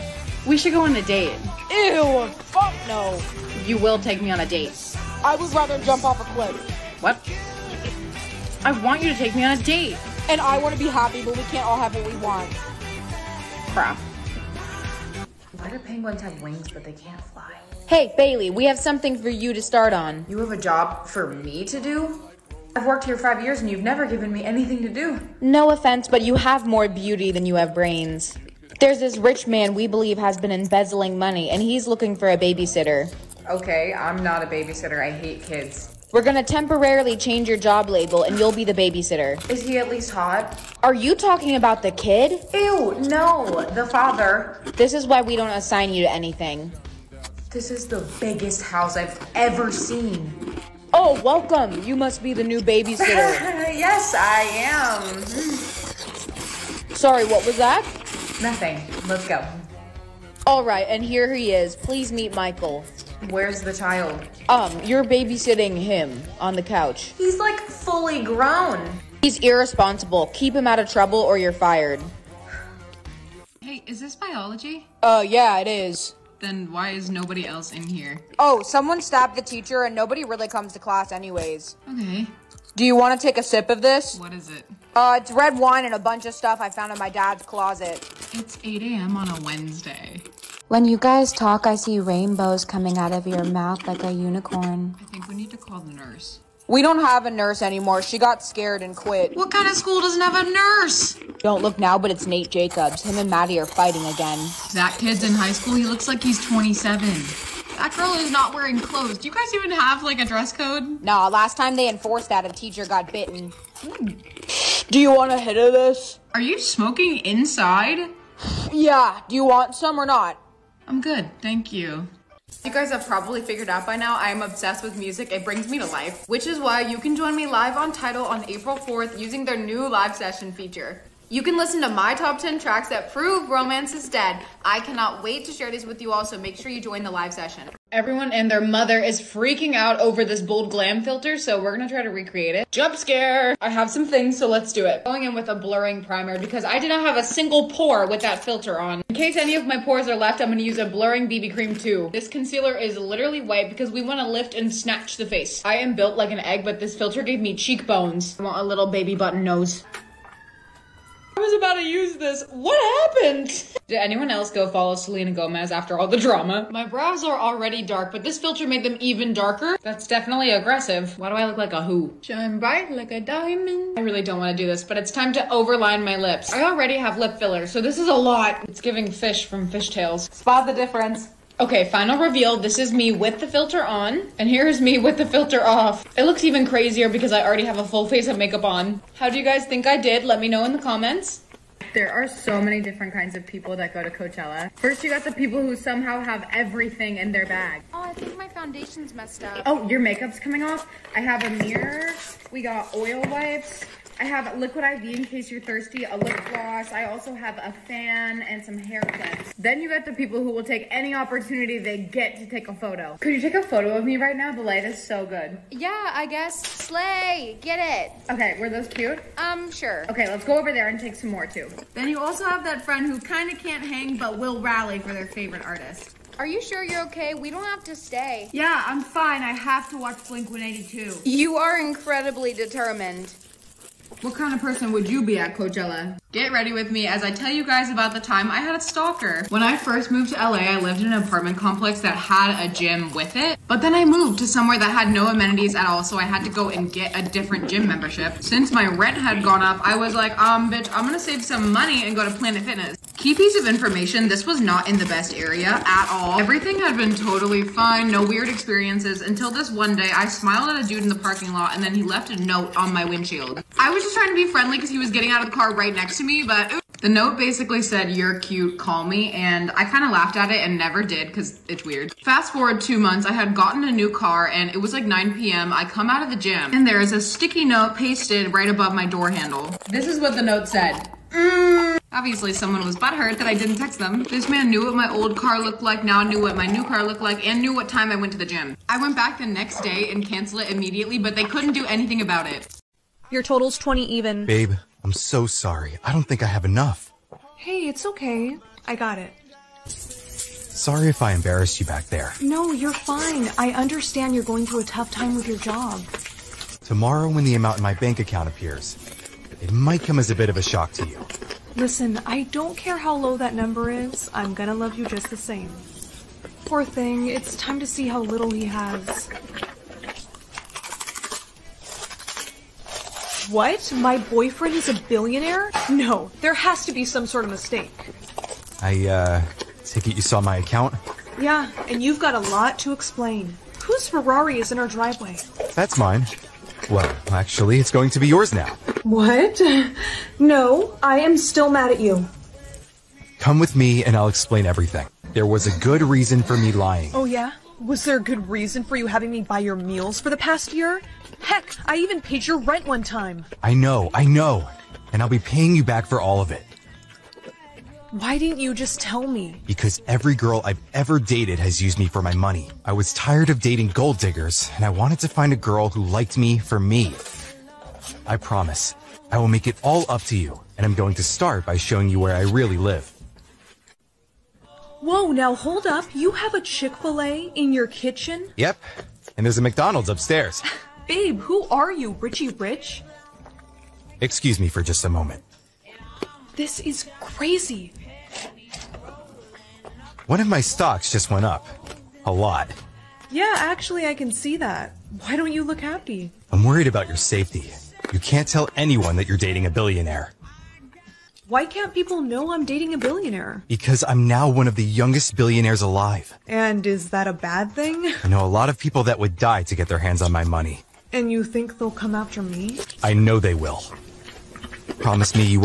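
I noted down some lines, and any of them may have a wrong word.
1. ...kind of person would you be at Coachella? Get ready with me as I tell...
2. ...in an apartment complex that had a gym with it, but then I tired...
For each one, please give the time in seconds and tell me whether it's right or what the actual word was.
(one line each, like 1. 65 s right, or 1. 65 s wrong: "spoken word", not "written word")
1. 234 s right
2. 241 s wrong: "moved", not "tired".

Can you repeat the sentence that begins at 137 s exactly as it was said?
Everyone and their mother is freaking out over this bold glam filter, so we're gonna try to recreate it.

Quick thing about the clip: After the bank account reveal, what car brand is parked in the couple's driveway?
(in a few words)
Ferrari.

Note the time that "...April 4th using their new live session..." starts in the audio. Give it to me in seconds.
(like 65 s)
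128 s.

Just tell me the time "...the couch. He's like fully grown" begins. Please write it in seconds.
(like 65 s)
66 s.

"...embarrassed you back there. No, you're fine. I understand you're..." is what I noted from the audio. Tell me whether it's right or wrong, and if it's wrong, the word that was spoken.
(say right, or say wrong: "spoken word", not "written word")
right.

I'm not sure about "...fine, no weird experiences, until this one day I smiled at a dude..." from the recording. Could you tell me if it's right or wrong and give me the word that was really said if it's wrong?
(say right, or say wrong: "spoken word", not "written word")
right.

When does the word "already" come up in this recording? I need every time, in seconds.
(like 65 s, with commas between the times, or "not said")
167 s, 176 s, 187 s.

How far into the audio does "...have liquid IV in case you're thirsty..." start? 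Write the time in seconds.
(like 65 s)
204 s.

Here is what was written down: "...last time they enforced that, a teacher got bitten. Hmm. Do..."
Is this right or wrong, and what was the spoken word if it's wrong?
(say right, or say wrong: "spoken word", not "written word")
right.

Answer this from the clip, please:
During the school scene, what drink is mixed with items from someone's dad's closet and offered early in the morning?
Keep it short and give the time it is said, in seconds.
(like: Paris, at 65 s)
red wine, at 85 s.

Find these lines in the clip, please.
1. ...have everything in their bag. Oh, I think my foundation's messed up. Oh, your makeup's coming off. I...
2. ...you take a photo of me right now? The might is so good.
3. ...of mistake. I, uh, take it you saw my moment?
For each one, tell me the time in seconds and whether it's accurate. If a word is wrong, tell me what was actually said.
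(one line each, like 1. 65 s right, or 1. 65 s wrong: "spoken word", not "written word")
1. 196 s right
2. 213 s wrong: "light", not "might"
3. 327 s wrong: "account", not "moment".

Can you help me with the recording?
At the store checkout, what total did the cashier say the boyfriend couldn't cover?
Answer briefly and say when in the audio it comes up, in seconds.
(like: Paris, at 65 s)
20, at 293 s.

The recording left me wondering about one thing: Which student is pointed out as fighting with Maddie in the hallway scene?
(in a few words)
Nate Jacobs.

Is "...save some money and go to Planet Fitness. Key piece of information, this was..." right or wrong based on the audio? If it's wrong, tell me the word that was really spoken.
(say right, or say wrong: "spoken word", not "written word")
right.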